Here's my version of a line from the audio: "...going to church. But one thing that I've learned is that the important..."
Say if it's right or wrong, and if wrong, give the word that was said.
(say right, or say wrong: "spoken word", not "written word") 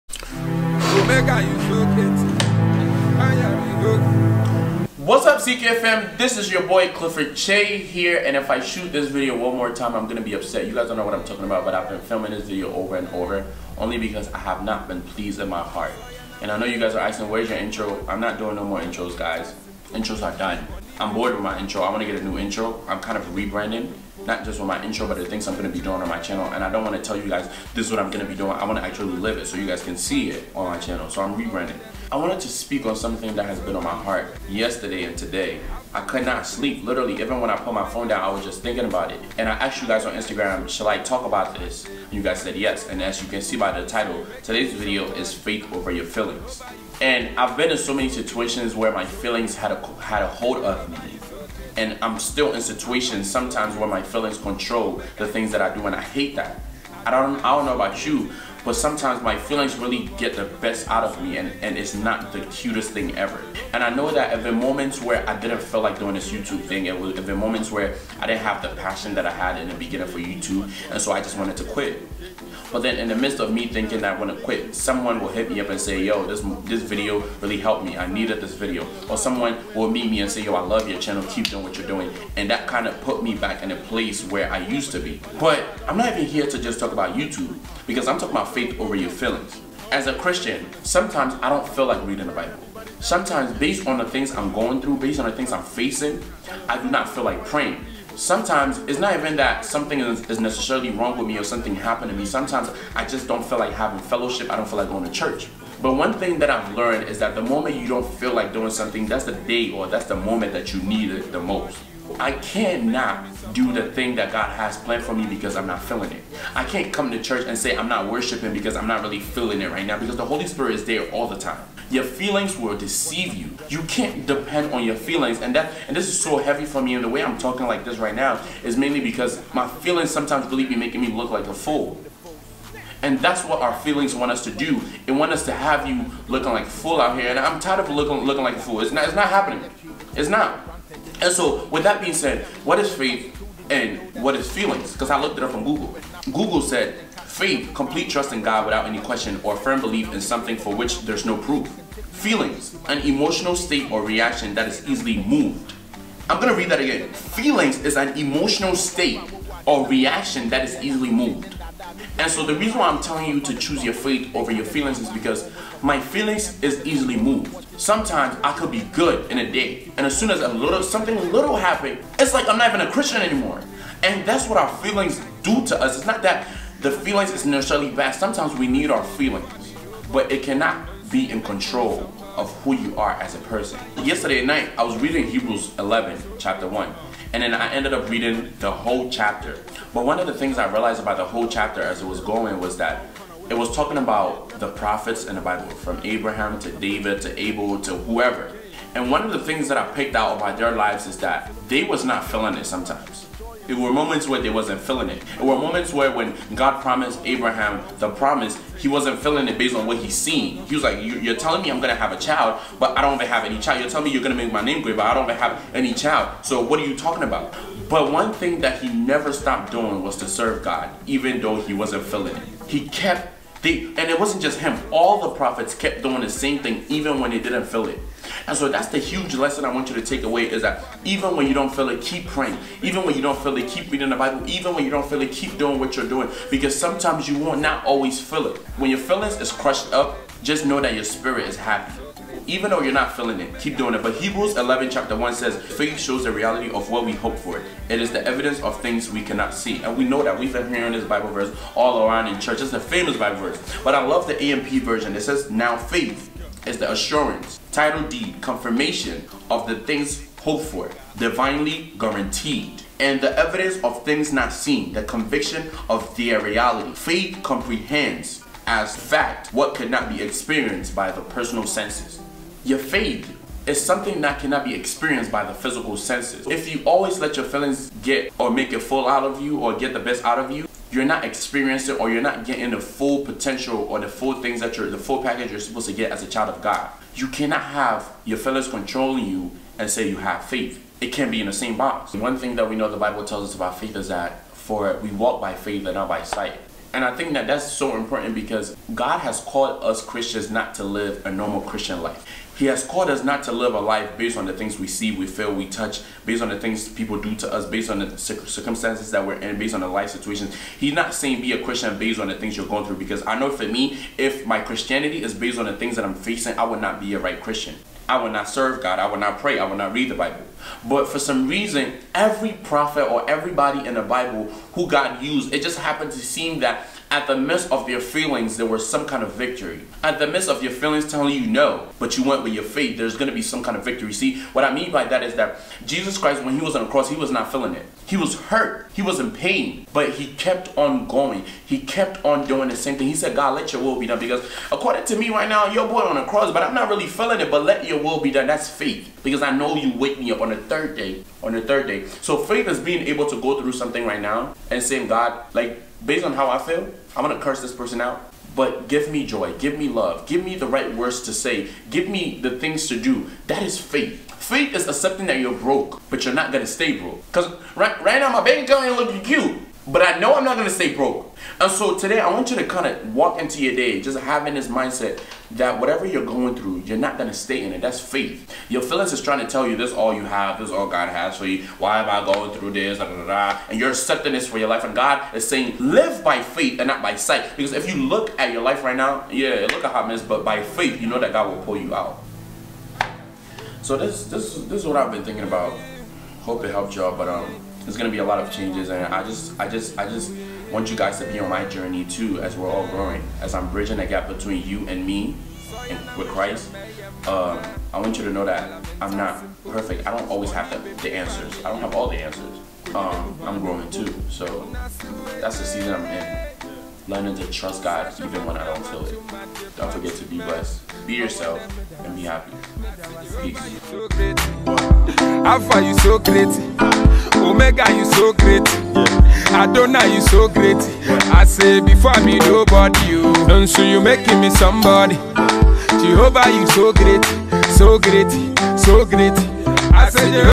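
wrong: "moment", not "important".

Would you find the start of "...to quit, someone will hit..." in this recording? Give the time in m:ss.
1:14.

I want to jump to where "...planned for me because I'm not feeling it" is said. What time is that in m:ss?
1:54.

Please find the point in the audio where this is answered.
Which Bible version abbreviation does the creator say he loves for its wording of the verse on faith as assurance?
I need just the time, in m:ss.
4:14.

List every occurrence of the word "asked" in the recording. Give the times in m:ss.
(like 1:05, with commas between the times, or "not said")
0:39.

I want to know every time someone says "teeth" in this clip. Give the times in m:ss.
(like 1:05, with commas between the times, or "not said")
not said.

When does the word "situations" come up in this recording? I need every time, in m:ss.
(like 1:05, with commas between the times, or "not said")
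0:48, 0:52, 5:10.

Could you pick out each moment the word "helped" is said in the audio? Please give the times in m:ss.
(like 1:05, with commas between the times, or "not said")
1:17, 6:36.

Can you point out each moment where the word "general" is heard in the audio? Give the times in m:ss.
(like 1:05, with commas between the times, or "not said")
not said.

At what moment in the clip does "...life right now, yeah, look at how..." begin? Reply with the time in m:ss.
6:28.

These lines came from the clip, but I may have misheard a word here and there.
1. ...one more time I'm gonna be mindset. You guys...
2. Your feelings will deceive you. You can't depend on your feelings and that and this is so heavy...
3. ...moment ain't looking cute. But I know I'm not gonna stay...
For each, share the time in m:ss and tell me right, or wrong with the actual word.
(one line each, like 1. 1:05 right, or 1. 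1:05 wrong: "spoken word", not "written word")
1. 0:09 wrong: "upset", not "mindset"
2. 2:01 right
3. 6:08 wrong: "account", not "moment".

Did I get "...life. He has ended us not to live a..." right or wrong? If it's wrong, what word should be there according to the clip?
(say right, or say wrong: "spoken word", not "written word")
wrong: "called", not "ended".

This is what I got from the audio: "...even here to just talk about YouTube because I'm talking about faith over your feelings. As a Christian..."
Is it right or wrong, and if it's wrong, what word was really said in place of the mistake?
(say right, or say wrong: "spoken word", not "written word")
right.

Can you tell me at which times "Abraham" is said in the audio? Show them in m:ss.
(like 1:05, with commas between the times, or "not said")
3:16, 3:27.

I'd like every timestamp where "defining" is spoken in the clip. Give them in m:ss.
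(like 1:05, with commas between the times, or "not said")
not said.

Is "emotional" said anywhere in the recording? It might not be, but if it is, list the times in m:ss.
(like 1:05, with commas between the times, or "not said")
2:32, 2:38.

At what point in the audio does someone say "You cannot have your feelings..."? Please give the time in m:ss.
4:47.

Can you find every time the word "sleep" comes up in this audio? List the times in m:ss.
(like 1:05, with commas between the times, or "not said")
0:36.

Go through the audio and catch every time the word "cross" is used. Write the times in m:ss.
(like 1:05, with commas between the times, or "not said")
5:36, 5:46.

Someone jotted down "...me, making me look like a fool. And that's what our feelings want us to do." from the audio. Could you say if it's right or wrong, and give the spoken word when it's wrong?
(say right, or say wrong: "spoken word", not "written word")
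right.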